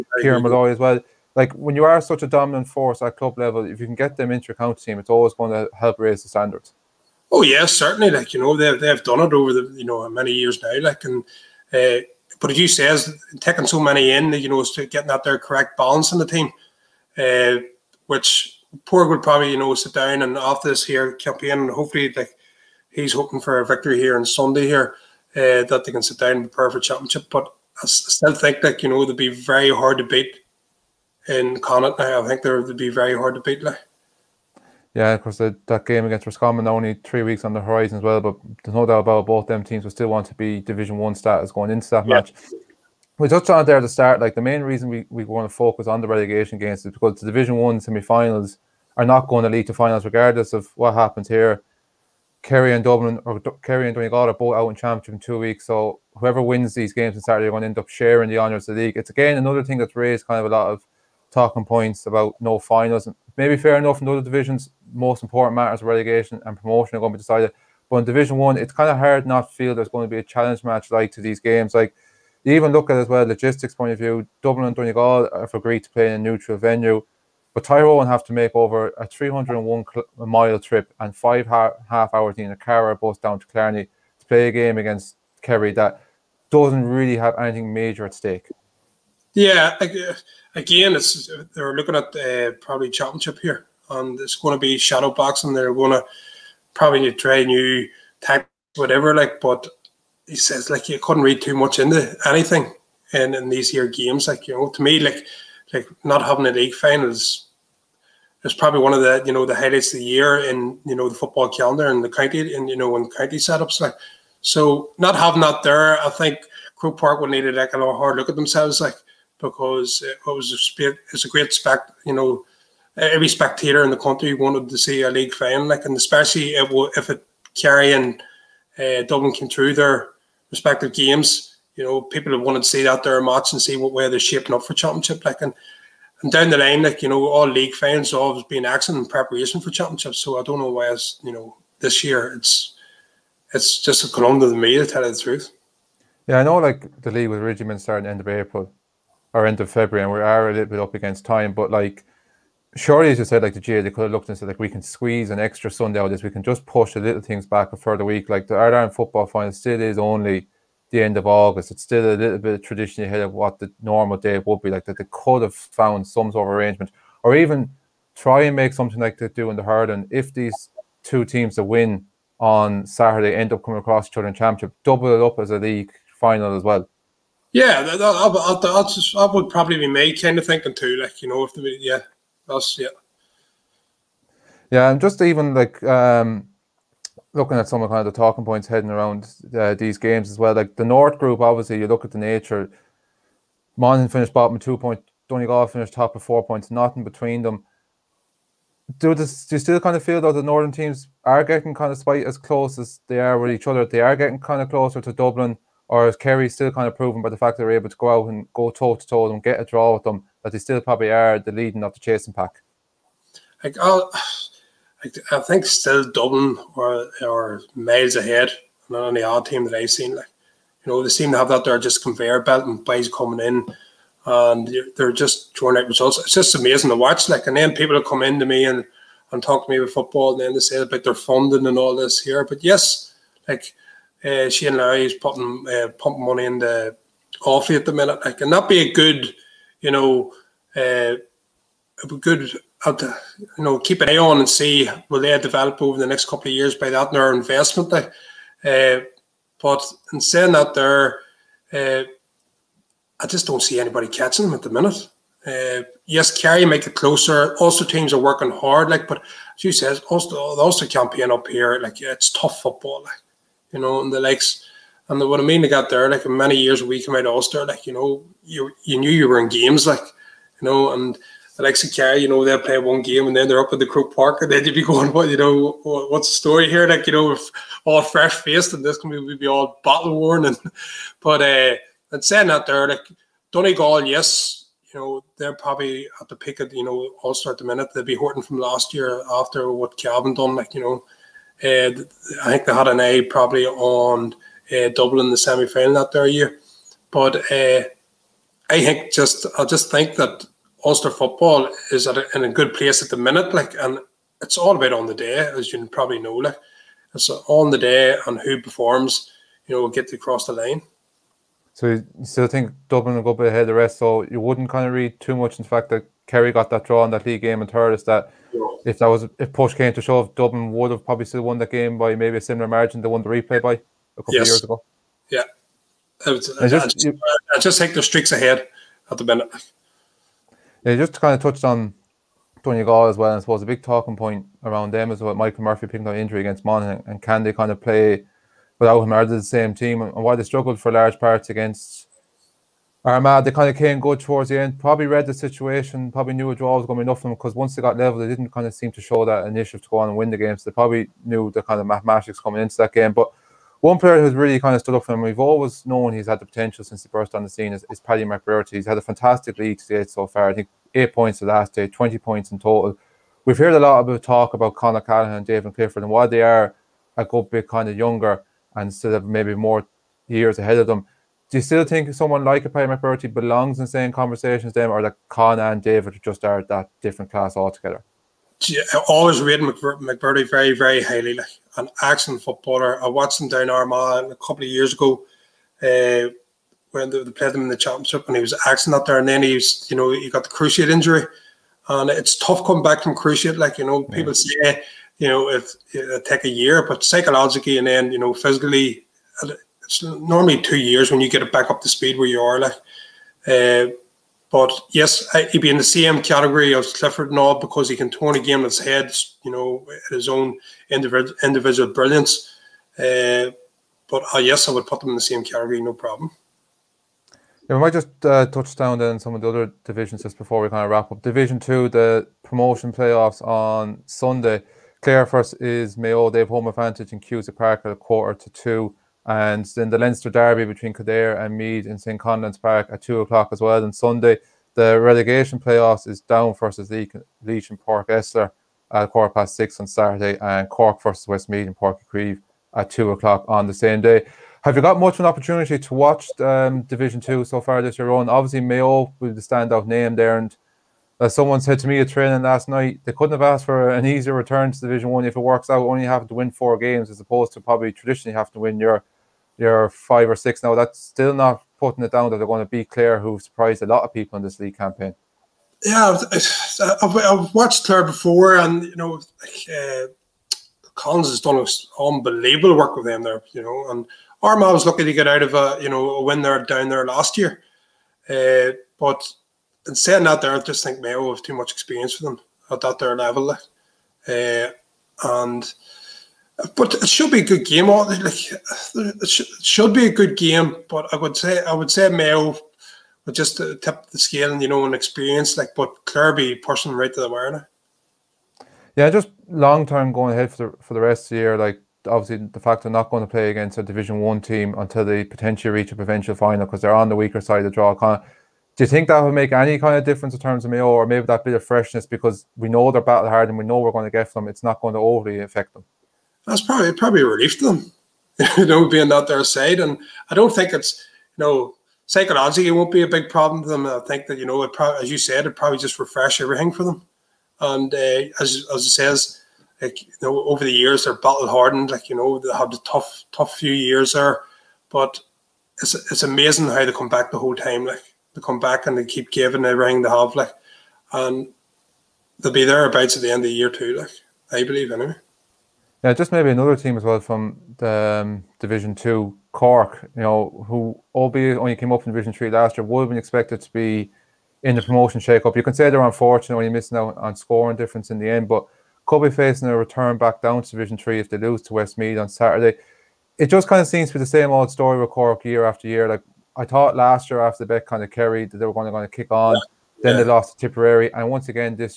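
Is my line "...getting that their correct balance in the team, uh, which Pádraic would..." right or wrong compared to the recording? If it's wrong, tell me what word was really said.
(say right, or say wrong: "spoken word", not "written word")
right.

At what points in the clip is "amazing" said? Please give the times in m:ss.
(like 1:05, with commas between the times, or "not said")
3:46, 8:56.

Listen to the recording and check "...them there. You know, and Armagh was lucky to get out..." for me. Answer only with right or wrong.
right.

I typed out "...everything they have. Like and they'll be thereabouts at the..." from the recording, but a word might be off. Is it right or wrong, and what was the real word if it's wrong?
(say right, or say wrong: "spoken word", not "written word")
right.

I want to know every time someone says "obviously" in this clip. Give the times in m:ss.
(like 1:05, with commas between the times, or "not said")
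3:11, 7:28, 8:22.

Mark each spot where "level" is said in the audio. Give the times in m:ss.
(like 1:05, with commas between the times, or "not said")
0:03, 5:47, 8:03.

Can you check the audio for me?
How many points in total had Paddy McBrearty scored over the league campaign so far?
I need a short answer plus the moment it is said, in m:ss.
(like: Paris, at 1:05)
20, at 6:01.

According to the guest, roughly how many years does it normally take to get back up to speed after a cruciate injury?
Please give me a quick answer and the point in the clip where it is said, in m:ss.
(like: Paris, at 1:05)
2, at 6:40.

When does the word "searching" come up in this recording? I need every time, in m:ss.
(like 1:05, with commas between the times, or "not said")
not said.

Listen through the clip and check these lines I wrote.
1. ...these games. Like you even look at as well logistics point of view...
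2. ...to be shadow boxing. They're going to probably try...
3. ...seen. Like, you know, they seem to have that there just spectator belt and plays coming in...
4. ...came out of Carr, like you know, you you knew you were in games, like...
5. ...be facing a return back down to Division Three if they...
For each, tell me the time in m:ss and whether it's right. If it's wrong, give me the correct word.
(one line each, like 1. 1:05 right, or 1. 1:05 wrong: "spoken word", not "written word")
1. 1:11 right
2. 1:34 right
3. 3:39 wrong: "conveyor", not "spectator"
4. 4:27 wrong: "Ulster", not "Carr"
5. 9:19 right.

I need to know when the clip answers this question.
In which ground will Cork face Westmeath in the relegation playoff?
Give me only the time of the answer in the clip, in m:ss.
7:21.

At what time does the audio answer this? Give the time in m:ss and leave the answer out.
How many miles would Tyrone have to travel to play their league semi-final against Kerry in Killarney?
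1:19.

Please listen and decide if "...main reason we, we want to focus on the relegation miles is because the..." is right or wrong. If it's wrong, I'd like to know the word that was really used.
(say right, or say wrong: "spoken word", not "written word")
wrong: "games", not "miles".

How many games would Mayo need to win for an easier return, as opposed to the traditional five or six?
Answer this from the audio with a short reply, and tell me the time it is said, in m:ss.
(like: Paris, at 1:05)
4, at 7:36.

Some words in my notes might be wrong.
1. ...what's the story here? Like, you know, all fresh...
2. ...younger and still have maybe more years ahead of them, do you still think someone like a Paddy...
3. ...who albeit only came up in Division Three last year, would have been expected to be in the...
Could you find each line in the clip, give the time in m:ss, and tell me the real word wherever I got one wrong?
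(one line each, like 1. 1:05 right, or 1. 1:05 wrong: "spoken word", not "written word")
1. 4:35 right
2. 6:07 right
3. 9:10 right.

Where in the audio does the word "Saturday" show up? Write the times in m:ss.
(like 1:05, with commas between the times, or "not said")
0:57, 2:52, 7:19, 9:22.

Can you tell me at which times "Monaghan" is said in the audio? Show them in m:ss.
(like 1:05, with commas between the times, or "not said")
3:13, 5:36.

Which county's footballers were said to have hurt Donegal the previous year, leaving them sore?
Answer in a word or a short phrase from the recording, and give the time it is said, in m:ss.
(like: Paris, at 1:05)
Cavan, at 4:49.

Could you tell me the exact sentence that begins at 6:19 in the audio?
always rated McBrearty very, very highly.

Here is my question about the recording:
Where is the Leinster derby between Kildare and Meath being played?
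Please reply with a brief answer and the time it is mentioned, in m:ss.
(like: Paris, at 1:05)
St. Conleth's Park, at 7:11.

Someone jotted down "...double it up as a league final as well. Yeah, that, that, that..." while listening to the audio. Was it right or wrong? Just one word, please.
right.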